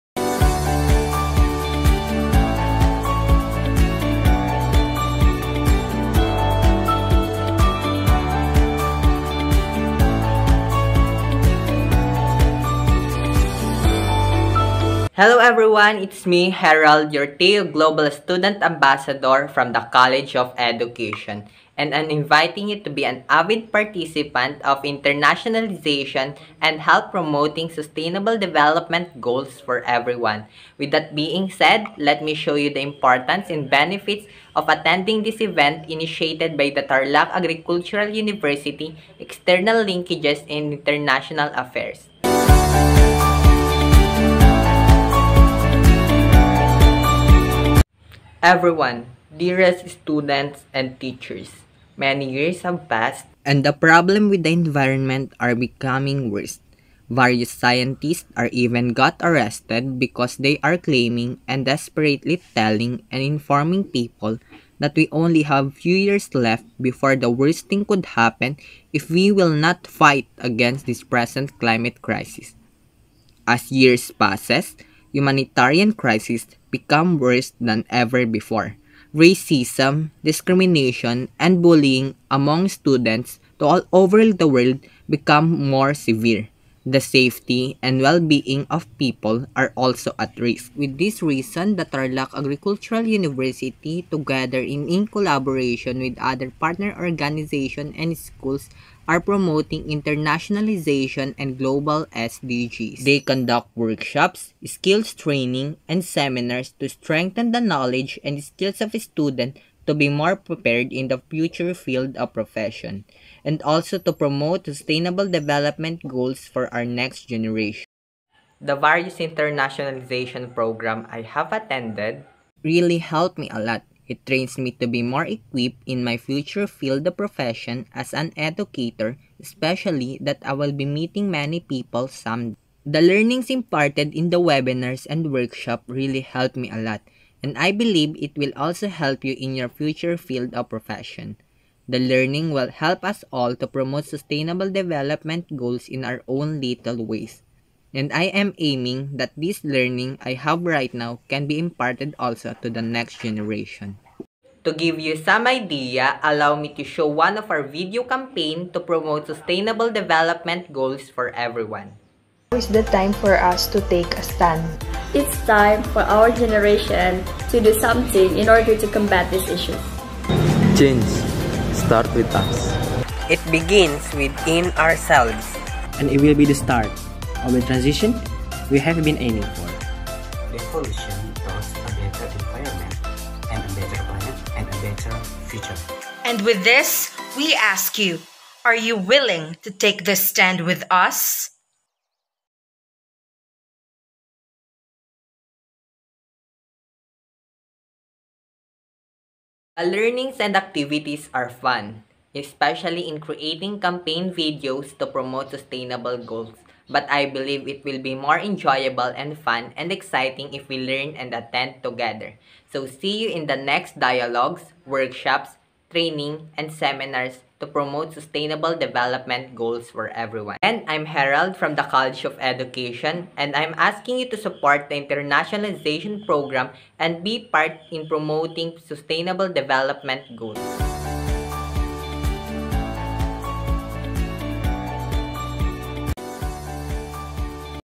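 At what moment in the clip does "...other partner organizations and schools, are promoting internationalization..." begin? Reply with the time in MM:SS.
01:36.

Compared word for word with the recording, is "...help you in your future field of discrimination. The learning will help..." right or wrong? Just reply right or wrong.
wrong.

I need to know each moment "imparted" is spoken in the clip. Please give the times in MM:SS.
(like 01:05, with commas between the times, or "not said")
02:13, 02:31.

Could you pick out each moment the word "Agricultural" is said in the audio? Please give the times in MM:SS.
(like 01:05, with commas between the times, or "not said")
00:37, 01:32.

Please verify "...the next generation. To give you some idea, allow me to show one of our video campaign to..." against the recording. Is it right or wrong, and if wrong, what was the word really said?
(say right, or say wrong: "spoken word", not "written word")
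right.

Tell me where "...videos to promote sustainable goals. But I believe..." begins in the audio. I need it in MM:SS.
03:24.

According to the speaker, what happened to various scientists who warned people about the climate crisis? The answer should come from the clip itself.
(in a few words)
arrested.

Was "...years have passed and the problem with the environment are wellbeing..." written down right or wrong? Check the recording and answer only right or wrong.
wrong.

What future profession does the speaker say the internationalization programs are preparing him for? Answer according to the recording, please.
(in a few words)
educator.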